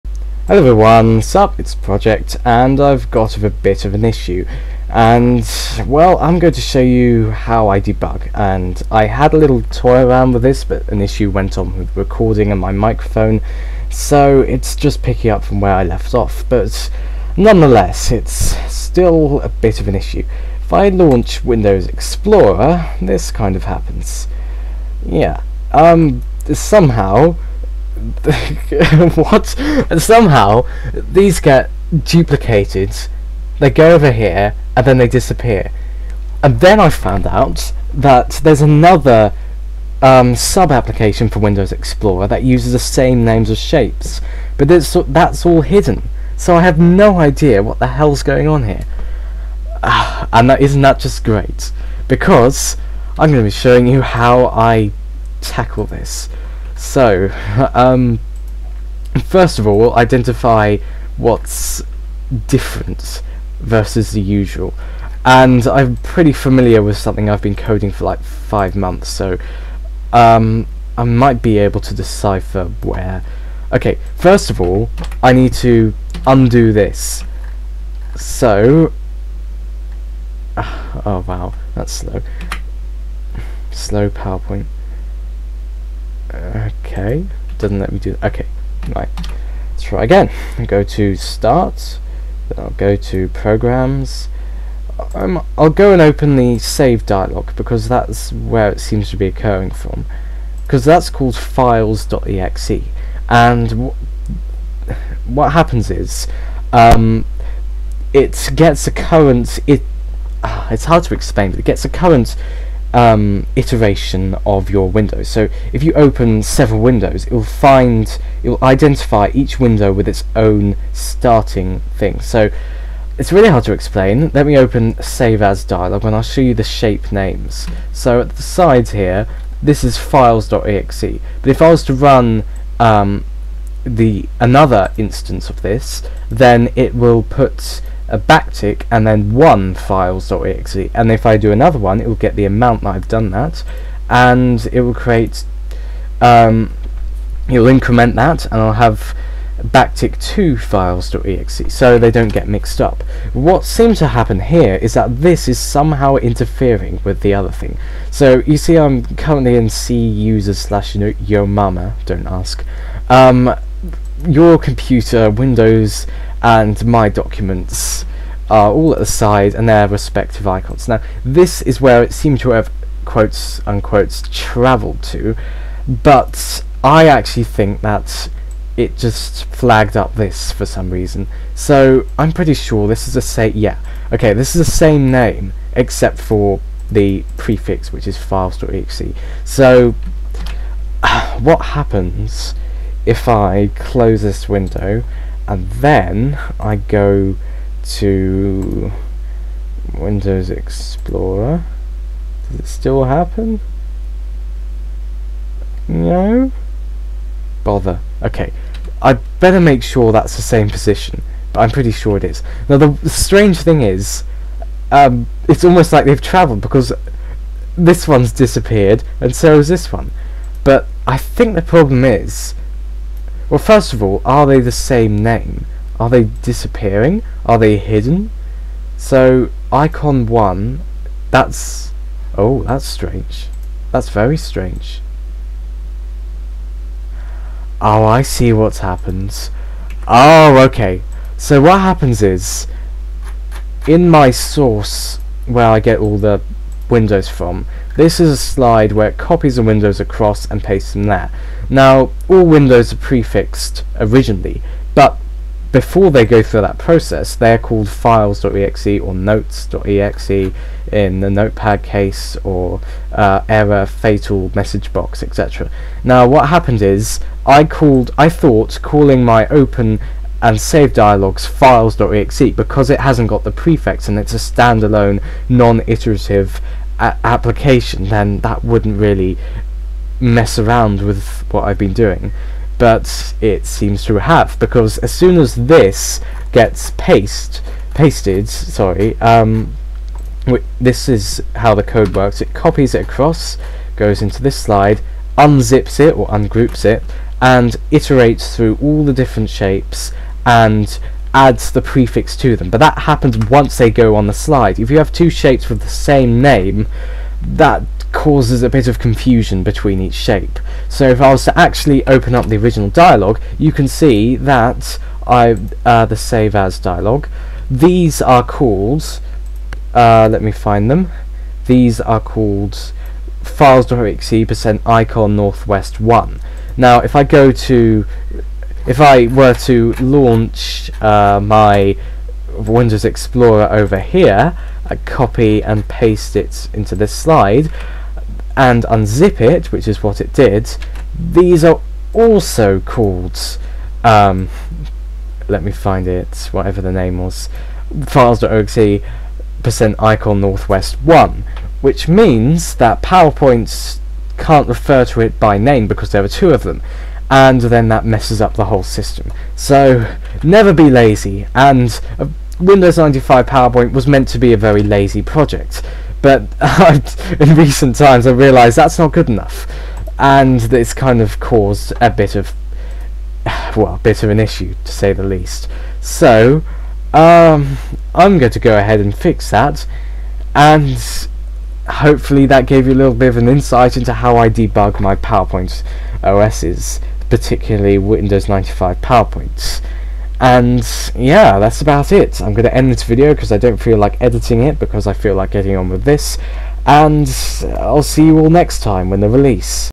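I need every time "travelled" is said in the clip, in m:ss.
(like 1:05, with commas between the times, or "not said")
2:54, 3:36.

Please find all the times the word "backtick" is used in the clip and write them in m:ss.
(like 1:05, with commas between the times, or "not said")
2:18, 2:29.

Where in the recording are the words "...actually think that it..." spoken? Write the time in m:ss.
2:57.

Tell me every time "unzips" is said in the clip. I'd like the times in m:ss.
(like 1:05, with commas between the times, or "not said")
4:55, 5:38.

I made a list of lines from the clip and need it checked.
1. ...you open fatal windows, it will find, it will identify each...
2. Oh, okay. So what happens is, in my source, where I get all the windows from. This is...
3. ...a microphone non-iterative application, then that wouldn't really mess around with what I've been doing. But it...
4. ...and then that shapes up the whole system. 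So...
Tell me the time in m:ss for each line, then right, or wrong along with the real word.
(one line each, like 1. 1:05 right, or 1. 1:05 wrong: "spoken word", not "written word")
1. 1:55 wrong: "several", not "fatal"
2. 4:00 right
3. 4:34 wrong: "standalone", not "microphone"
4. 5:57 wrong: "messes", not "shapes".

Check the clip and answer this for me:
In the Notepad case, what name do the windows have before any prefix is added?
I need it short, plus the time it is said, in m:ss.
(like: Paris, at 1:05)
notes.exe, at 4:19.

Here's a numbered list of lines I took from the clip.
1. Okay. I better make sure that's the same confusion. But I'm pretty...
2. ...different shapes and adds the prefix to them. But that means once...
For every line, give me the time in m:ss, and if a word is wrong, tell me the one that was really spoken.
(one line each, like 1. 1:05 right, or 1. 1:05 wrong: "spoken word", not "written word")
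1. 3:28 wrong: "position", not "confusion"
2. 4:59 wrong: "happens", not "means".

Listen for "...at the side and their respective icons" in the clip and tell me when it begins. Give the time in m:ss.
2:48.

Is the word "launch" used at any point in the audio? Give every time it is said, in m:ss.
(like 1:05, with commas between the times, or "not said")
0:20, 5:29.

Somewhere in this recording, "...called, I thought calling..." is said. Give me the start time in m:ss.
4:27.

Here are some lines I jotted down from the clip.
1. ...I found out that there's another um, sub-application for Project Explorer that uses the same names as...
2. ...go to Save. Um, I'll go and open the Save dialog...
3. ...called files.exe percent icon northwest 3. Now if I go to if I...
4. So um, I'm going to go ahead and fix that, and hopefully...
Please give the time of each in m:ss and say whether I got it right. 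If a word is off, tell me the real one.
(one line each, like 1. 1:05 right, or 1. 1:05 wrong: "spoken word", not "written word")
1. 0:36 wrong: "Windows", not "Project"
2. 1:32 wrong: "Programs", not "Save"
3. 5:22 wrong: "1", not "3"
4. 6:16 right.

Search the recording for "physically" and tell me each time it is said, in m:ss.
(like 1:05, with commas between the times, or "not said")
not said.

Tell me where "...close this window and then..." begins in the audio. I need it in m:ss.
3:13.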